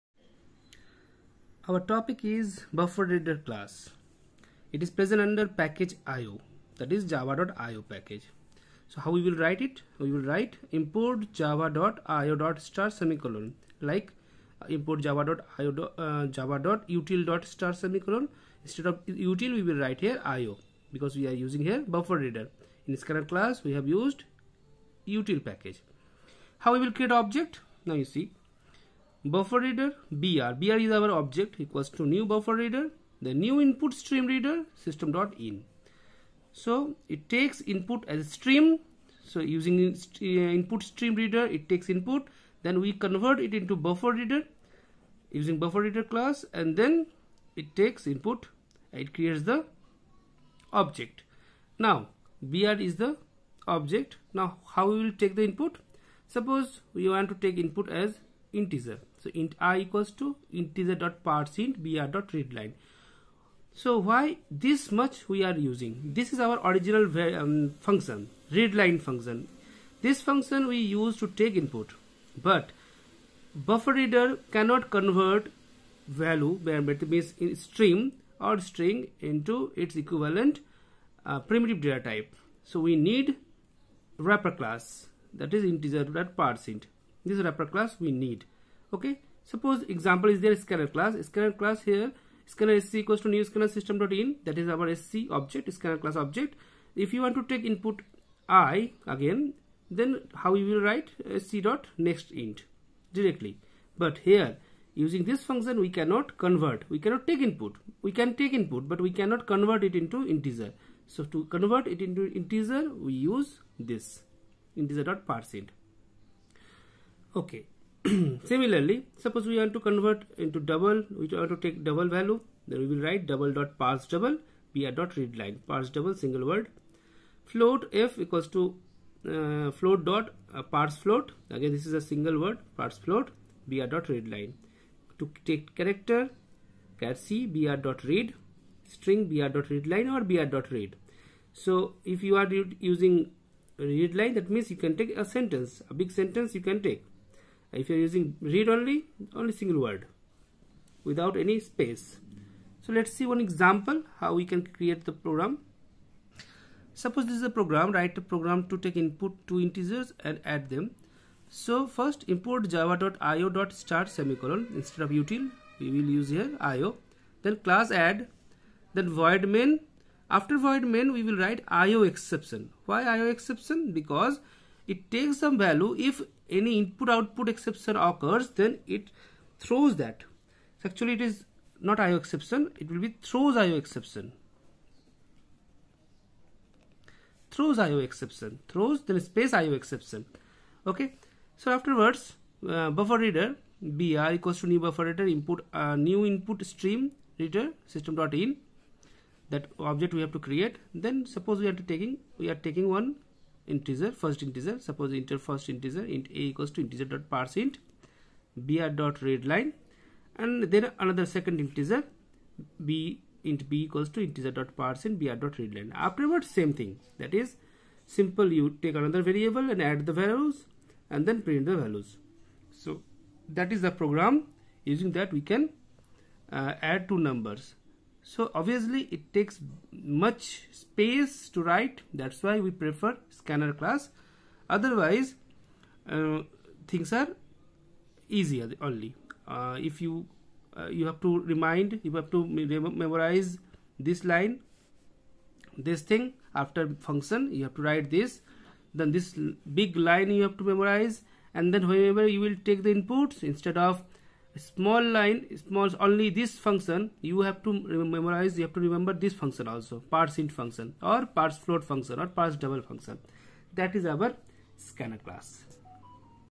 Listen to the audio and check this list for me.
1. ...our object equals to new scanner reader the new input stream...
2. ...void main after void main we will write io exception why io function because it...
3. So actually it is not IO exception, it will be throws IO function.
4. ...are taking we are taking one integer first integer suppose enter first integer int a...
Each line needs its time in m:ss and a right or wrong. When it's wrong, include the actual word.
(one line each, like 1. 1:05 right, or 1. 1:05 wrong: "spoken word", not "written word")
1. 0:30 wrong: "buffer", not "scanner"
2. 2:49 wrong: "exception", not "function"
3. 3:00 wrong: "exception", not "function"
4. 3:21 right.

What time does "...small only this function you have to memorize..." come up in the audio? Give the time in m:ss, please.
4:15.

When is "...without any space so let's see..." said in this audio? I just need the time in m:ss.
2:31.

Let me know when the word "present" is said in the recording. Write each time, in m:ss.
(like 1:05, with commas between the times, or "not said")
0:04.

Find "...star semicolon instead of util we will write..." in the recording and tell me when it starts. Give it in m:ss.
0:17.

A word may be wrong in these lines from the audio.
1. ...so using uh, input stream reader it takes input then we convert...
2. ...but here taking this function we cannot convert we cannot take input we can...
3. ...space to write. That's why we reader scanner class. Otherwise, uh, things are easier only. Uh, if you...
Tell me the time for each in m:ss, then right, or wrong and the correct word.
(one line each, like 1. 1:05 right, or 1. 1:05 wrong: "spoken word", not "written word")
1. 0:39 right
2. 1:44 wrong: "using", not "taking"
3. 3:50 wrong: "prefer", not "reader".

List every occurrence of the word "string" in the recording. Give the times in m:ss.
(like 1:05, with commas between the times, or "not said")
1:18, 2:18.